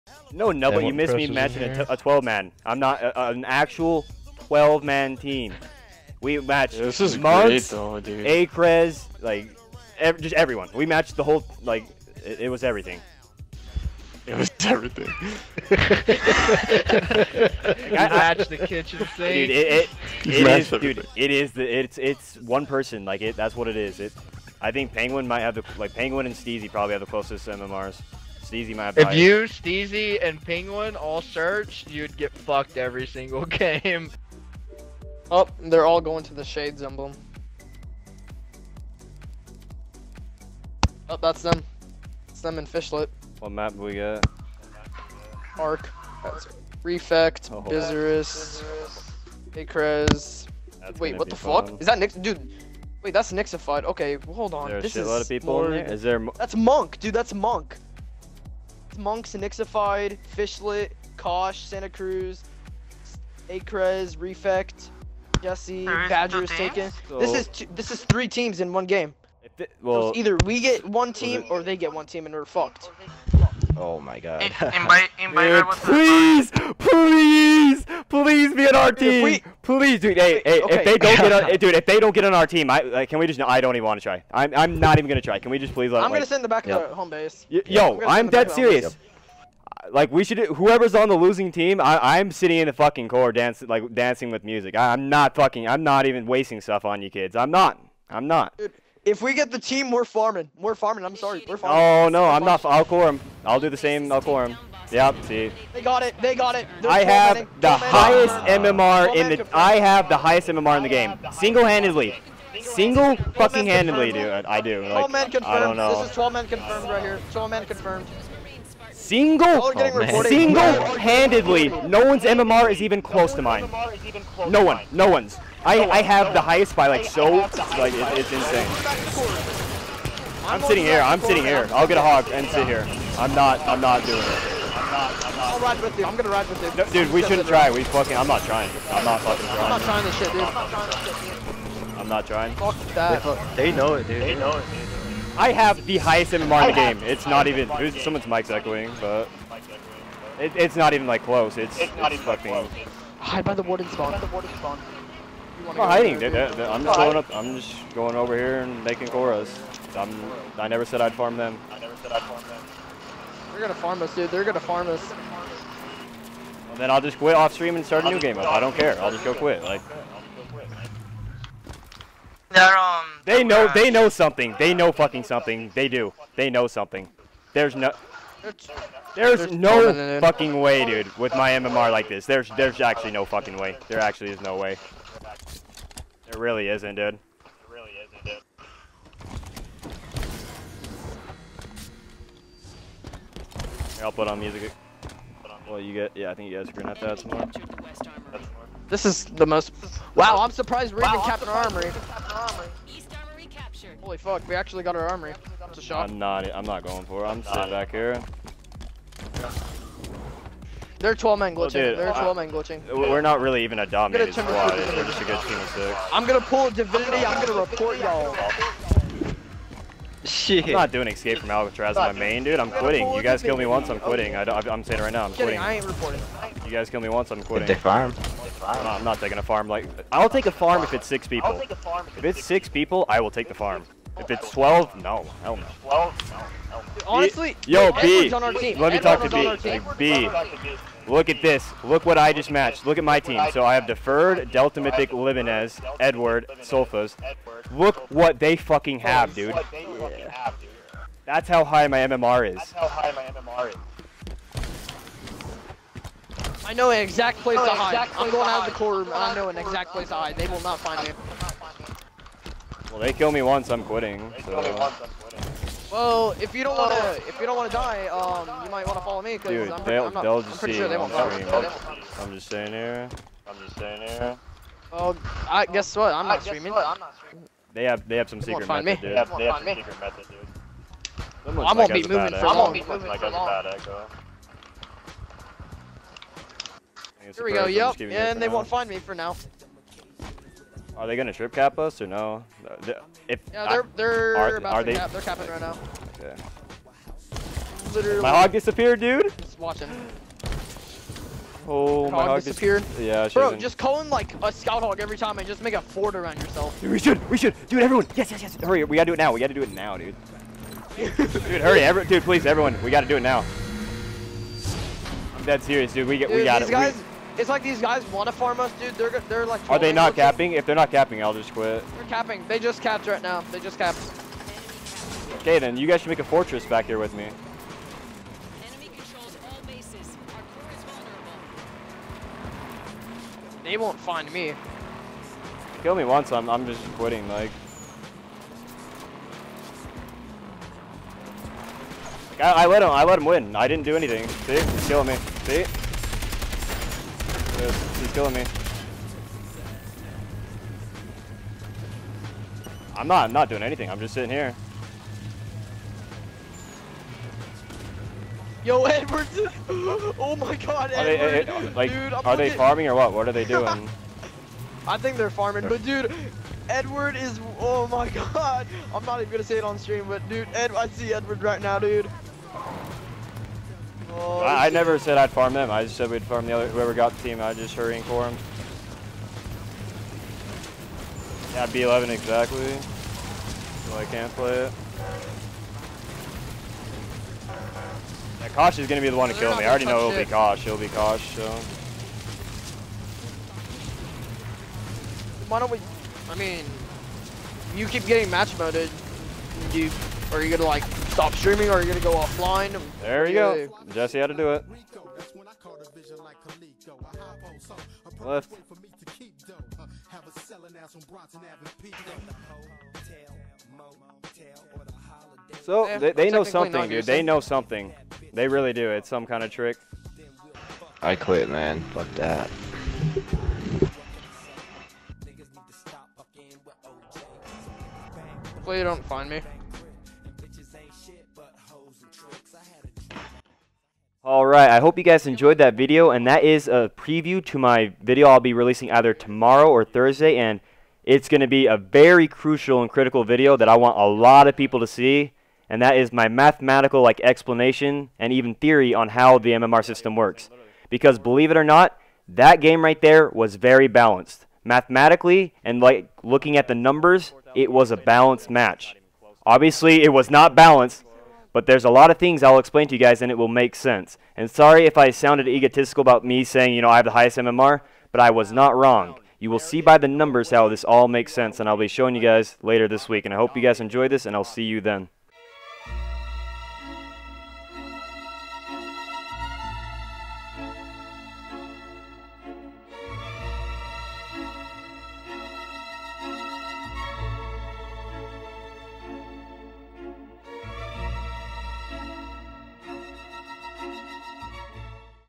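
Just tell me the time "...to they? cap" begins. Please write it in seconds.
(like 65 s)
294 s.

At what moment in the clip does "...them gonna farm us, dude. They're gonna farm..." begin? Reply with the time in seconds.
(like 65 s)
162 s.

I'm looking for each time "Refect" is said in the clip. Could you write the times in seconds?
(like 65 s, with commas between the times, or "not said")
46 s, 64 s.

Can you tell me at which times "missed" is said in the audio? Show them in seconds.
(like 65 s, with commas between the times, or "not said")
0 s.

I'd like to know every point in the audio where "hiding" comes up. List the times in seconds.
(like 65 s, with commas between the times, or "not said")
155 s.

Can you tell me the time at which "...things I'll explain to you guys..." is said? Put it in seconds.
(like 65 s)
462 s.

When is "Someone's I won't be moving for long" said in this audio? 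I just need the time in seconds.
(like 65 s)
281 s.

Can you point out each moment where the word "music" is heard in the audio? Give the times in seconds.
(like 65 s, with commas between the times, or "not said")
94 s, 194 s.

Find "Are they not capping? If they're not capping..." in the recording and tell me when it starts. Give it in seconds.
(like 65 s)
319 s.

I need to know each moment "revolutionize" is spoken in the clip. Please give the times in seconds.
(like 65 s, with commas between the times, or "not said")
not said.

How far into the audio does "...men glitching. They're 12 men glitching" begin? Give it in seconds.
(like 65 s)
211 s.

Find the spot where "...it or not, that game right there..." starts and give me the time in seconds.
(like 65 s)
451 s.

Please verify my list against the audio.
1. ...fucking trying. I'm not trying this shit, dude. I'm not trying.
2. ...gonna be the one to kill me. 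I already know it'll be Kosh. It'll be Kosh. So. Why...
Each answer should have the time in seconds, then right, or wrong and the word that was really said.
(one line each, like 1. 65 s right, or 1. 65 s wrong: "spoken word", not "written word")
1. 139 s right
2. 388 s right.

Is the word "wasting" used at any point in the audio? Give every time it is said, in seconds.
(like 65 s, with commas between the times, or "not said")
96 s.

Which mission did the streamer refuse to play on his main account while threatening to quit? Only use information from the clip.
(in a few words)
Escape from Alcatraz.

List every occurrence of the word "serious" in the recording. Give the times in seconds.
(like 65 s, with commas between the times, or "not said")
88 s, 315 s.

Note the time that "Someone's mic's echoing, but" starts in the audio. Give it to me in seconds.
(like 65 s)
147 s.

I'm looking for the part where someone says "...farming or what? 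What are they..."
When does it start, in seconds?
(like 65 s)
362 s.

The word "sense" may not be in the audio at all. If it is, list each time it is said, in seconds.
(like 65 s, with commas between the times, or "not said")
463 s, 471 s.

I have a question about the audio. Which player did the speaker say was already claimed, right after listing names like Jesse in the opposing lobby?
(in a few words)
Badger.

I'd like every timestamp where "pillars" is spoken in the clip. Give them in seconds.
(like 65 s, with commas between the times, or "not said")
not said.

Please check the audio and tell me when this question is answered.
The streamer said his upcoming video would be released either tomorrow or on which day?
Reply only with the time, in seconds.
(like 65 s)
439 s.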